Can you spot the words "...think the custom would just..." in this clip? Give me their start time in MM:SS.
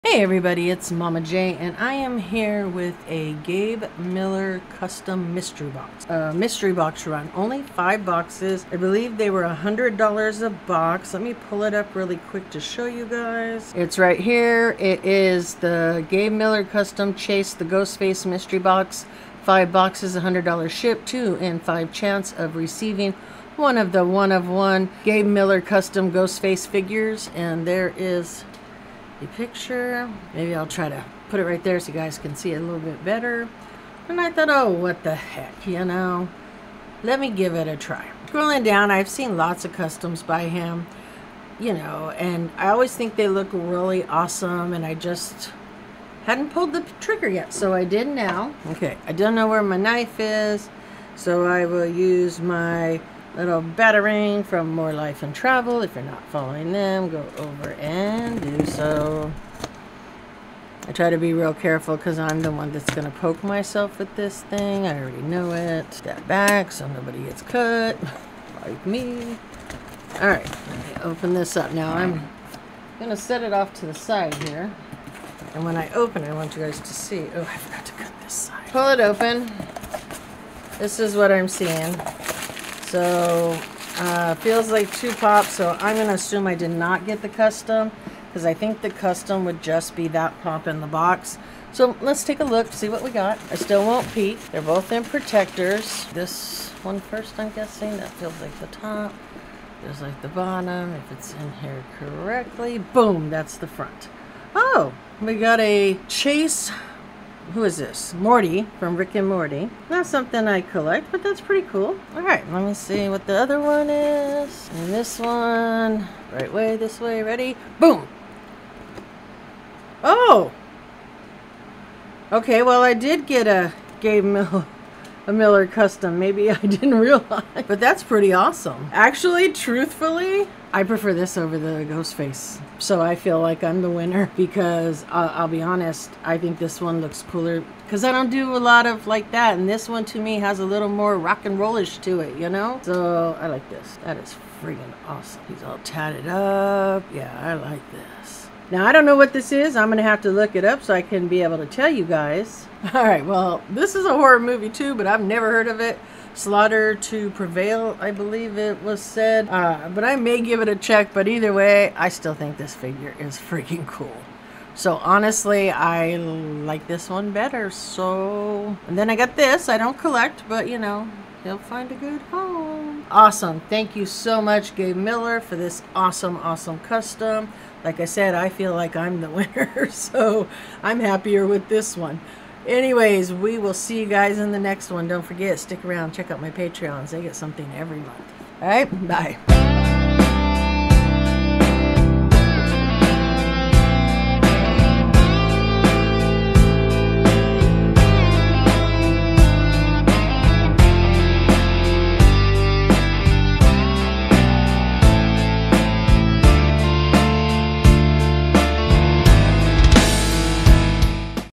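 01:28.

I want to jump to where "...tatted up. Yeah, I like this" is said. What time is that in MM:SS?
02:25.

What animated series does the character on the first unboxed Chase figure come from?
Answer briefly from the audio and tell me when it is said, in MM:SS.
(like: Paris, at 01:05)
Rick and Morty, at 01:48.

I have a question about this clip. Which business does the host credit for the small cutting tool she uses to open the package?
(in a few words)
More Life and Travel.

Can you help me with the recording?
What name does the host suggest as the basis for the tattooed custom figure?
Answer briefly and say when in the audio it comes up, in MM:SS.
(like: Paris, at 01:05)
Slaughter to Prevail, at 02:36.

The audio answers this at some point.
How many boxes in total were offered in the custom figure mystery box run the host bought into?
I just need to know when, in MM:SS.
00:07.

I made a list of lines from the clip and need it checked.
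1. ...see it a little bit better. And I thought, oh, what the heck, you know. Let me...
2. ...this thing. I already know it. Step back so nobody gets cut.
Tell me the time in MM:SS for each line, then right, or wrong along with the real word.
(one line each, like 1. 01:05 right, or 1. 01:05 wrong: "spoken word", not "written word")
1. 00:32 right
2. 01:04 right.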